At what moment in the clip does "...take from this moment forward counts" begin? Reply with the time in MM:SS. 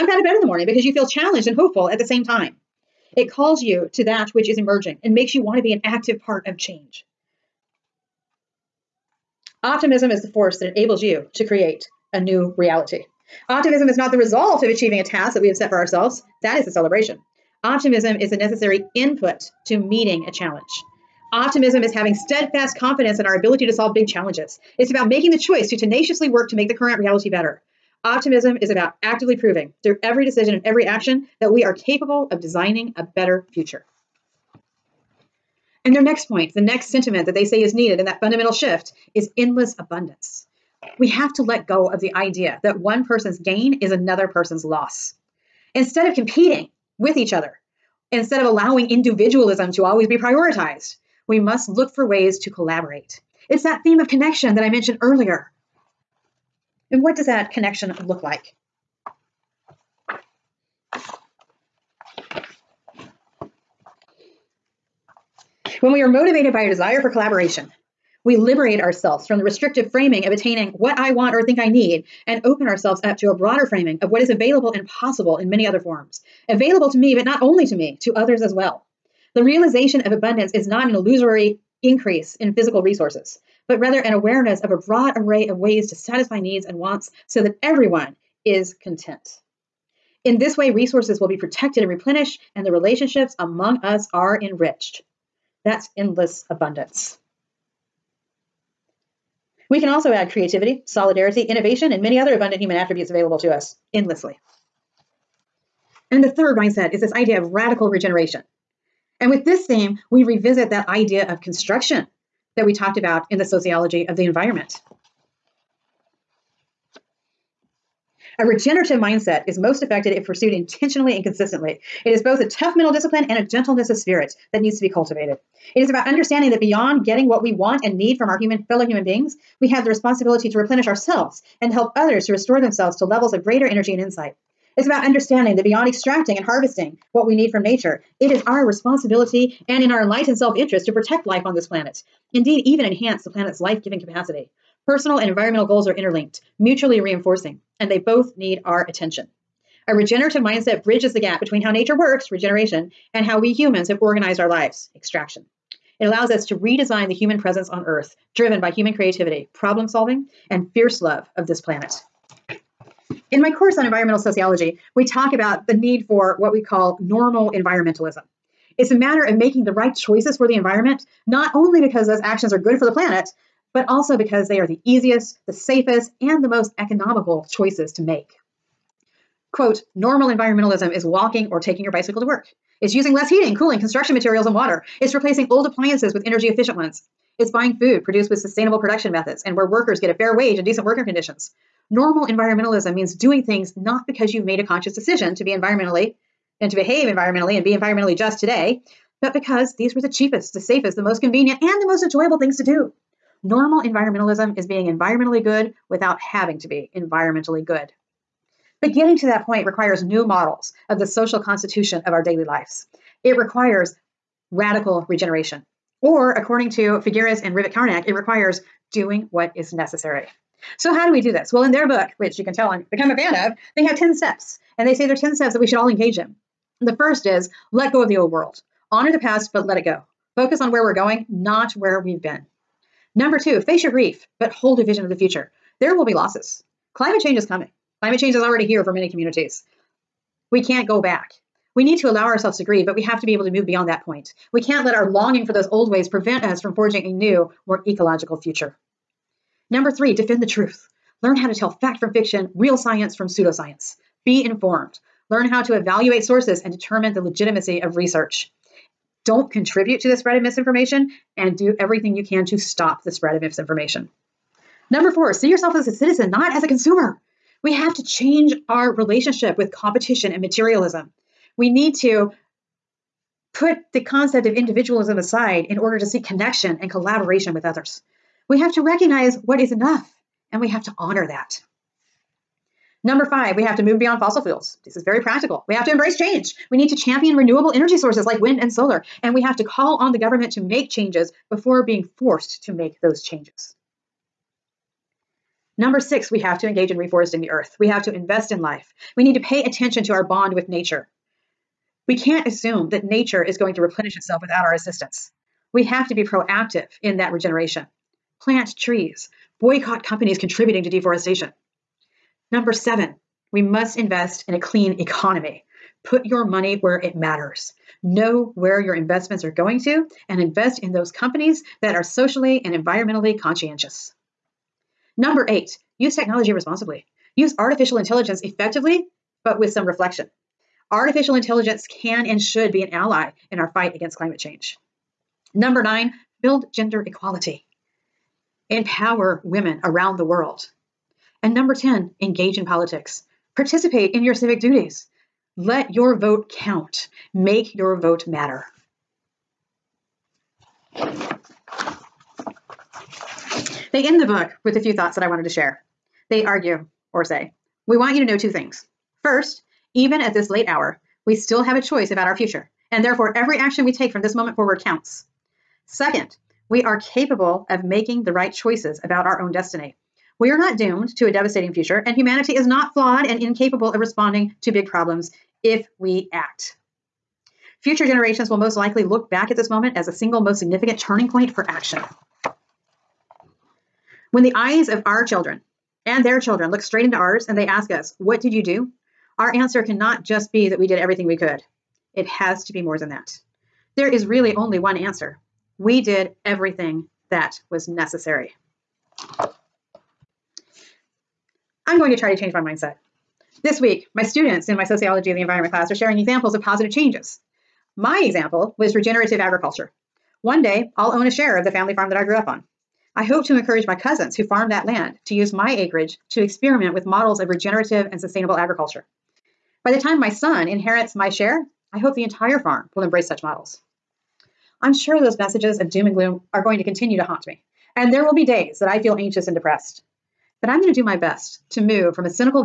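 06:03.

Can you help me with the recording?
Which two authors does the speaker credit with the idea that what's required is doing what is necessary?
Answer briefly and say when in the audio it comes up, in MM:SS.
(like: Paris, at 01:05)
Figueres and Rivett-Carnac, at 03:37.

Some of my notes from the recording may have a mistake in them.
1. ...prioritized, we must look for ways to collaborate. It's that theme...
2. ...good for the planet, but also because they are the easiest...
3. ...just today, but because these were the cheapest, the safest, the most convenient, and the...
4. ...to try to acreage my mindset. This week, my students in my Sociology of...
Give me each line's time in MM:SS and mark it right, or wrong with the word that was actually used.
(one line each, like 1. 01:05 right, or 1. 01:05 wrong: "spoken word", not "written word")
1. 00:50 right
2. 02:52 right
3. 03:18 right
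4. 06:42 wrong: "change", not "acreage".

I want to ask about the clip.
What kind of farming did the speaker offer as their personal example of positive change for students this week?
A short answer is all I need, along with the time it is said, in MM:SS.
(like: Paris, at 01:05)
regenerative agriculture, at 06:48.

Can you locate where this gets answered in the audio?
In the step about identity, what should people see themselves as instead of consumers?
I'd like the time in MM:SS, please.
04:25.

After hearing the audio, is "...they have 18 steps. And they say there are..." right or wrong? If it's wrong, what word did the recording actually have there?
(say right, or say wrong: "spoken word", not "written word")
wrong: "10", not "18".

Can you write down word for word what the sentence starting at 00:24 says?
It's about making the choice to tenaciously work to make the current reality better.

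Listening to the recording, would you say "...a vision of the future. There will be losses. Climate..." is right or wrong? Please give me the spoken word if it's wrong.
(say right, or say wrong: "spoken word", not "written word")
right.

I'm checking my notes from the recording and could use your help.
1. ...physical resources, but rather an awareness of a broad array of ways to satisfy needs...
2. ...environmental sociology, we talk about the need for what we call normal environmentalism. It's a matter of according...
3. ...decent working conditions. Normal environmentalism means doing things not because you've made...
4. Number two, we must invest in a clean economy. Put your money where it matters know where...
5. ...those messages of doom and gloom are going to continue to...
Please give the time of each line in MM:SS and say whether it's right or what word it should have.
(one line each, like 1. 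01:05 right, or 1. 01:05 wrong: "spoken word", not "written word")
1. 01:22 right
2. 02:43 wrong: "making", not "according"
3. 03:10 right
4. 05:12 wrong: "seven", not "two"
5. 07:05 right.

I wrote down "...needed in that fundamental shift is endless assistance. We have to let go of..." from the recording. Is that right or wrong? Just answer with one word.
wrong.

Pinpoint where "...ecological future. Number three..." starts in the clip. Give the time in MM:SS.
04:07.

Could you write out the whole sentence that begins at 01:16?
Available to me, but not only to me, to others as well.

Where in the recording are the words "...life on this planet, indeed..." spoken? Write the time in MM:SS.
02:21.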